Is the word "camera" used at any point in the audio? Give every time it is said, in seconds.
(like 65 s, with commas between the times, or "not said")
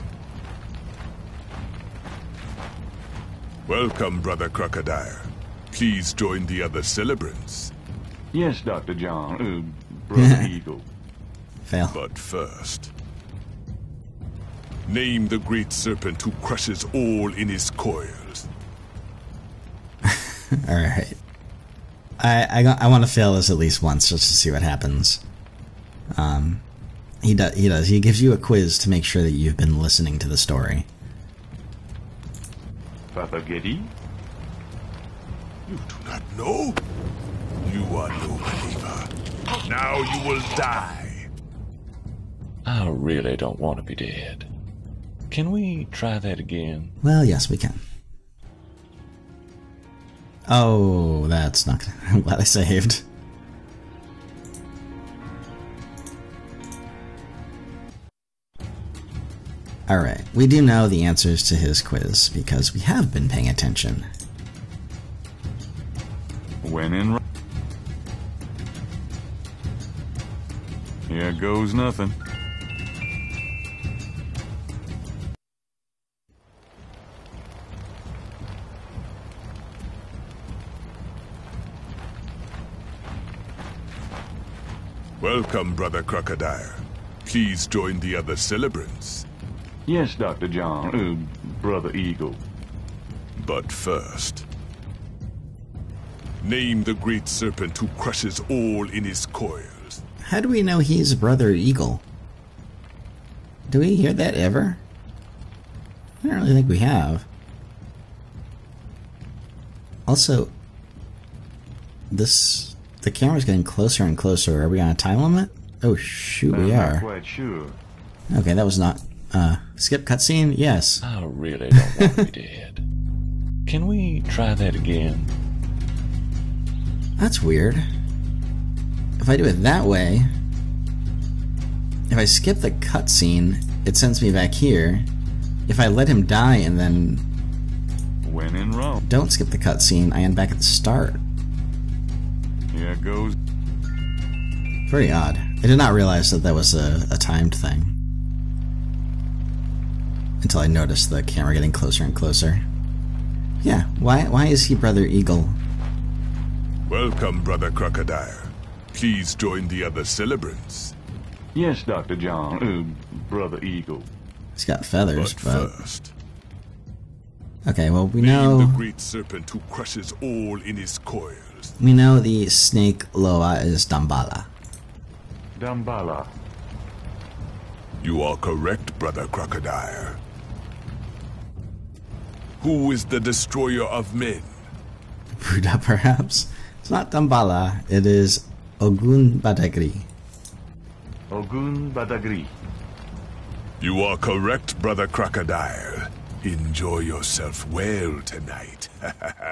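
113 s, 151 s.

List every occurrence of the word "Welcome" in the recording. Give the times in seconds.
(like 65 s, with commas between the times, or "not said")
3 s, 85 s, 156 s.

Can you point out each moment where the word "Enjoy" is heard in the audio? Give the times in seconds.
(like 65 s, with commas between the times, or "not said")
196 s.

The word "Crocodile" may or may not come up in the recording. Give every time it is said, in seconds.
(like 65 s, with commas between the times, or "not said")
4 s, 86 s, 157 s, 179 s, 195 s.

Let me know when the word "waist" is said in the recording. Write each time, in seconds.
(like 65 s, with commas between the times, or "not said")
not said.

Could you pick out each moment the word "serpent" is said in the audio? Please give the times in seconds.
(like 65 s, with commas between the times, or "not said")
15 s, 97 s, 168 s.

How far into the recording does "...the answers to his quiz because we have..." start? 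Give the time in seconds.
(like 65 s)
60 s.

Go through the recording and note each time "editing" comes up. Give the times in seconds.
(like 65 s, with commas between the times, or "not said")
not said.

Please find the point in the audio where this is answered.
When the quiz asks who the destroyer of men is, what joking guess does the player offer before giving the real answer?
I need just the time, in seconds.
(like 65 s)
185 s.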